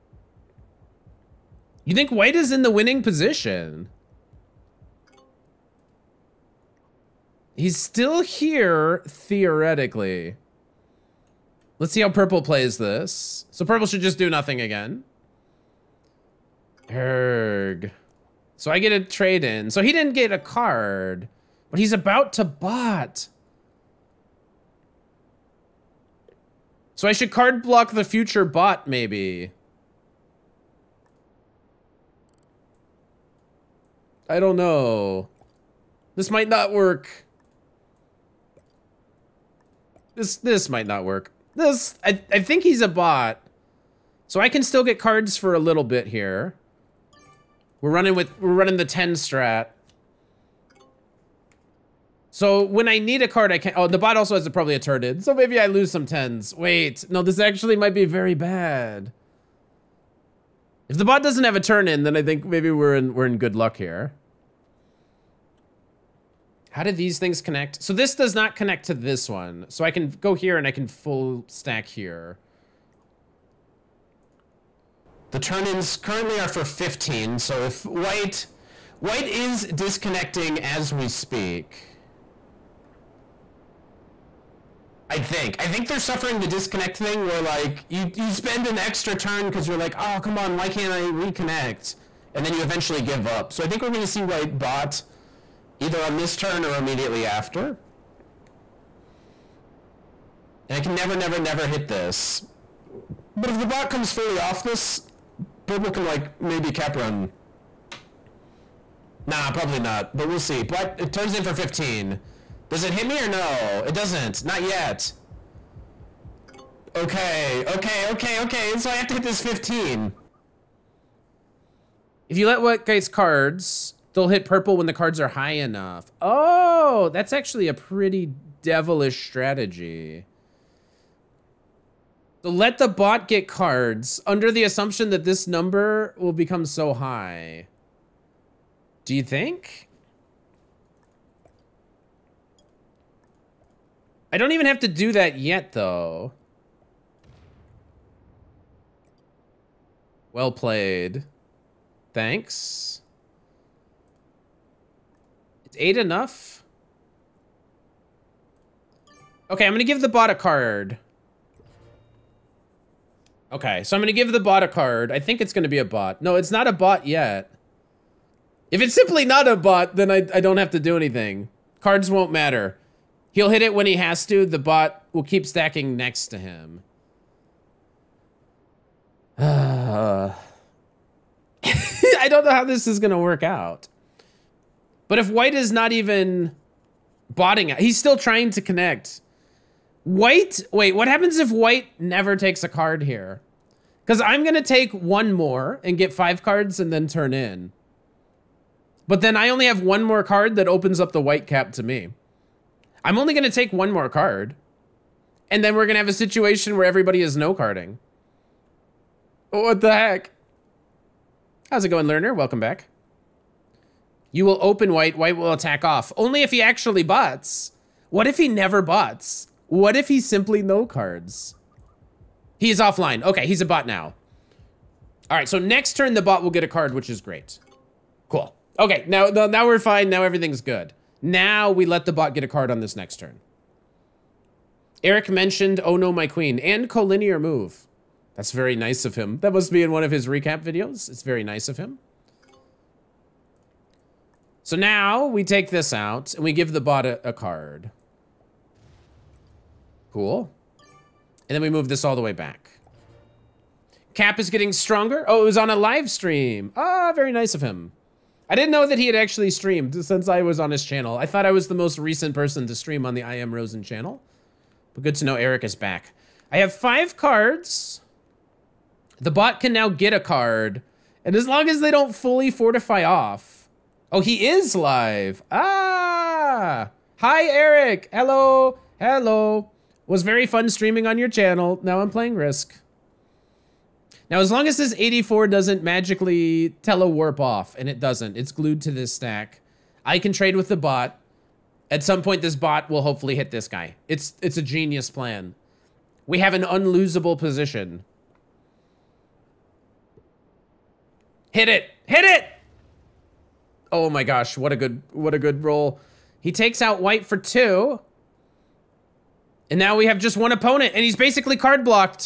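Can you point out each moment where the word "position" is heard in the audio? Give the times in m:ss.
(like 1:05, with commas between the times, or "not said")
0:03, 4:57.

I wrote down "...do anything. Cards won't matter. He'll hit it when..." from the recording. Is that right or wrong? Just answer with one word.
right.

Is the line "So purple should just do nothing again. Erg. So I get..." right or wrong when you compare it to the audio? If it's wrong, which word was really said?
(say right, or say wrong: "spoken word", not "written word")
right.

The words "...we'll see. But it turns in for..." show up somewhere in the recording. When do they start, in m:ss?
1:50.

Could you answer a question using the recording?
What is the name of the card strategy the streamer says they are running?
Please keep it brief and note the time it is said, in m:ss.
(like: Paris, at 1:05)
the 10 strat, at 0:48.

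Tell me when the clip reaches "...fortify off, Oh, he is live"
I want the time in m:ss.
4:32.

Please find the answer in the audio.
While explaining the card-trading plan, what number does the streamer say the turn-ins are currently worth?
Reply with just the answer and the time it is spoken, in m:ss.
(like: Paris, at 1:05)
15, at 1:15.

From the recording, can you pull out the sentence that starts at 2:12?
So let the bot get cards under the assumption that this number will become so high.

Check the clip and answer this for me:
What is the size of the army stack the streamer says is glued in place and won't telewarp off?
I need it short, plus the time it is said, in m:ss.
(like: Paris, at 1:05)
84, at 4:44.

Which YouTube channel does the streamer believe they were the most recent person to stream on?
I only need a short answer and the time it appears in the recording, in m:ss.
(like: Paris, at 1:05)
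I Am Rosen, at 4:23.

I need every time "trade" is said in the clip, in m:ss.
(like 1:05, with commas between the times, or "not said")
0:19, 4:50.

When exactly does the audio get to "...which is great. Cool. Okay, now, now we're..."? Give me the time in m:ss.
3:46.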